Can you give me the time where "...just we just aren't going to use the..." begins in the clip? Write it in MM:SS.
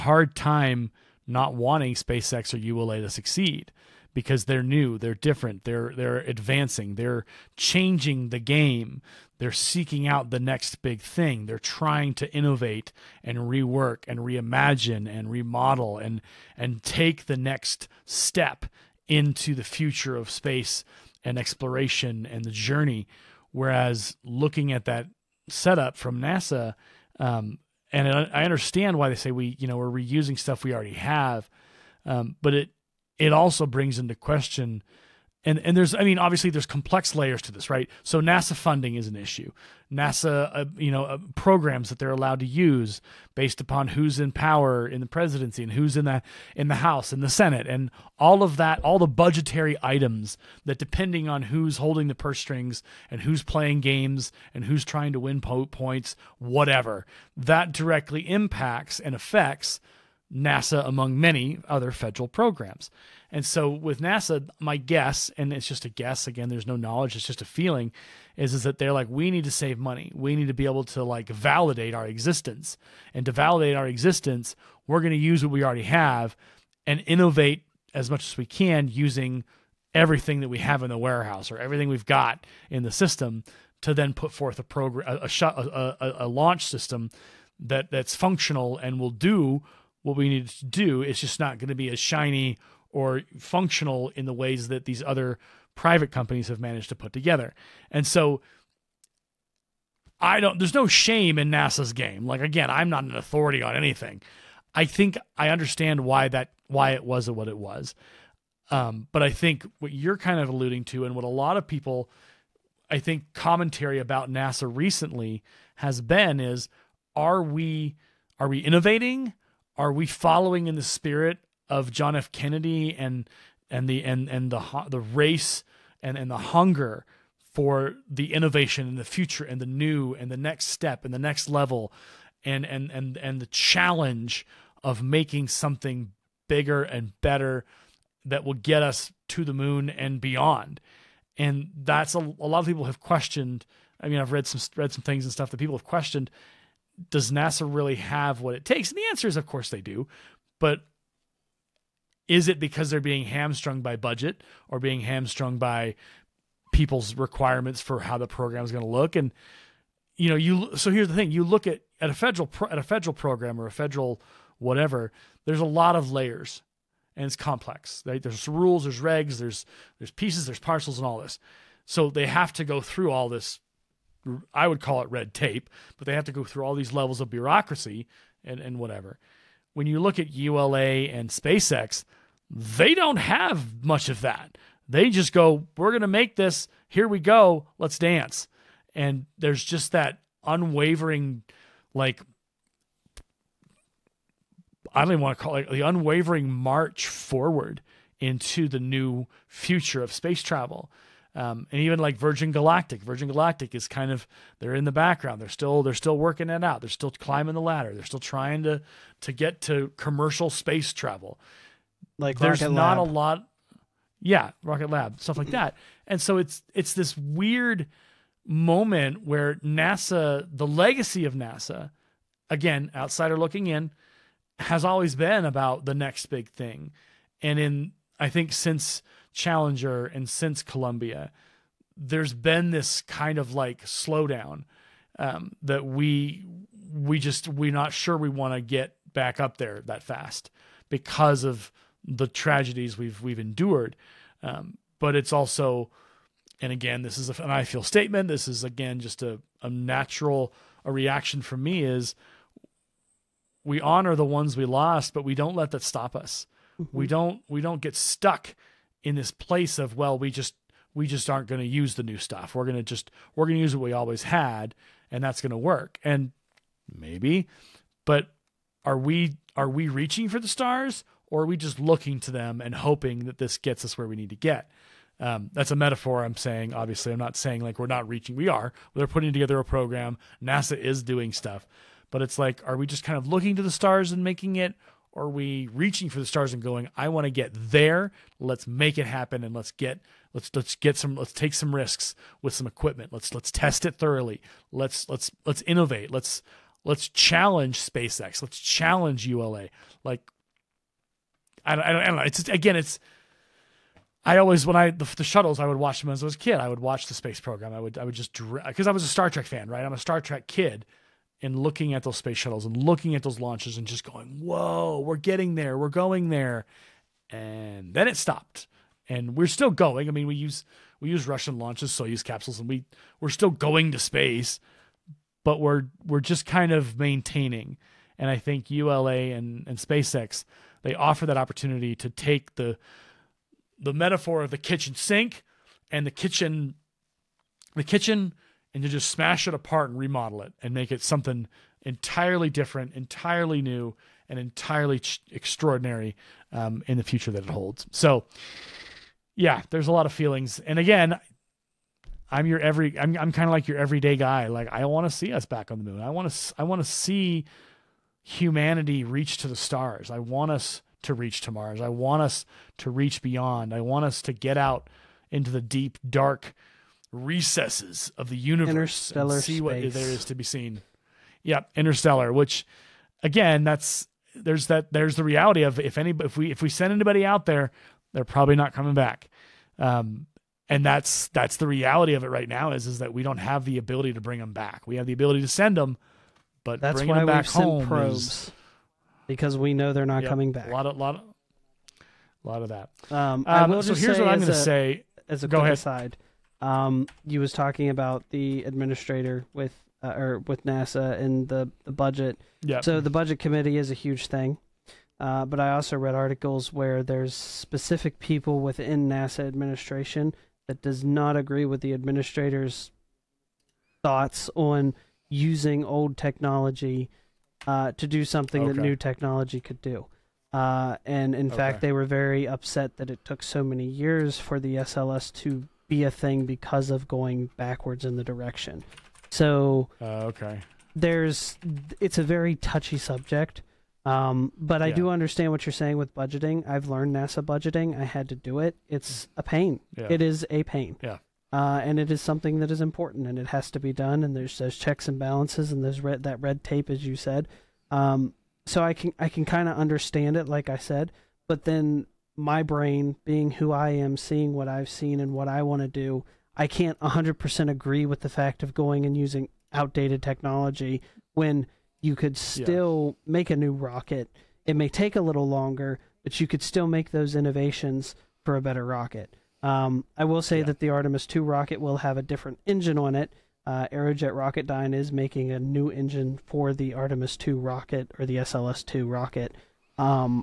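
04:20.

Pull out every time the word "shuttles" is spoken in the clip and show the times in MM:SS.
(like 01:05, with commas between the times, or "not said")
05:05, 05:12.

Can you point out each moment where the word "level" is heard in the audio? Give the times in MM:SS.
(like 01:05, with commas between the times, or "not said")
02:11, 02:56.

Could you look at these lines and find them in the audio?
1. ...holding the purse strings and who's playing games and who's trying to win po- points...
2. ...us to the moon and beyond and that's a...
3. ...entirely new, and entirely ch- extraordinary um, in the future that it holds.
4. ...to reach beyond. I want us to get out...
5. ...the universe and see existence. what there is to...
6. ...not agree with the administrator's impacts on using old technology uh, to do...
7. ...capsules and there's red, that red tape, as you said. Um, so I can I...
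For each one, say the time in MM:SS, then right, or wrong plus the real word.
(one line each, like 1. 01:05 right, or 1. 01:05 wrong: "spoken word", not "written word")
1. 00:51 right
2. 02:18 right
3. 05:42 right
4. 06:02 right
5. 06:08 wrong: "space", not "existence"
6. 06:51 wrong: "thoughts", not "impacts"
7. 07:25 wrong: "balances", not "capsules".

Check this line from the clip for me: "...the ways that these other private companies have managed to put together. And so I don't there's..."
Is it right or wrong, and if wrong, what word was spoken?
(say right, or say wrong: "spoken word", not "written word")
right.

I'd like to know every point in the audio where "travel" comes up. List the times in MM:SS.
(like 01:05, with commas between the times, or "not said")
03:20, 03:30.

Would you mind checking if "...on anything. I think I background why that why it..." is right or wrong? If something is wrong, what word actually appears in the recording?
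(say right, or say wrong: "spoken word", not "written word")
wrong: "understand", not "background".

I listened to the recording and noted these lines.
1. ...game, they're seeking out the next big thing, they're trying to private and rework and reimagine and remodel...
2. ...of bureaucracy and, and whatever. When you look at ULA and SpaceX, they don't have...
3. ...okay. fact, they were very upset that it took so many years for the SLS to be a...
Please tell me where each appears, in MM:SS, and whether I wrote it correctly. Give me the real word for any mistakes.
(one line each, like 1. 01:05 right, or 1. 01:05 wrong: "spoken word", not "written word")
1. 00:08 wrong: "innovate", not "private"
2. 02:57 right
3. 07:01 right.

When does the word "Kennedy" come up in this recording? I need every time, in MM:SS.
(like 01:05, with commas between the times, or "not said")
02:02.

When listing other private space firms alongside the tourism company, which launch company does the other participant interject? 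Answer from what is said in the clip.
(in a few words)
Rocket Lab.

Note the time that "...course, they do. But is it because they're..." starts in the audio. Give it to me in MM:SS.
02:29.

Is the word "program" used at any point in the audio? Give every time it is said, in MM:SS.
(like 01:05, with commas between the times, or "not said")
00:41, 01:02, 01:24, 02:38, 02:43, 04:39, 05:07.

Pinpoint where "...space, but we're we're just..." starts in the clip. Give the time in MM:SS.
05:23.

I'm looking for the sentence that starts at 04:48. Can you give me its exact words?
Let's make it happen and let's get let's let's get some let's take some risks with some equipment.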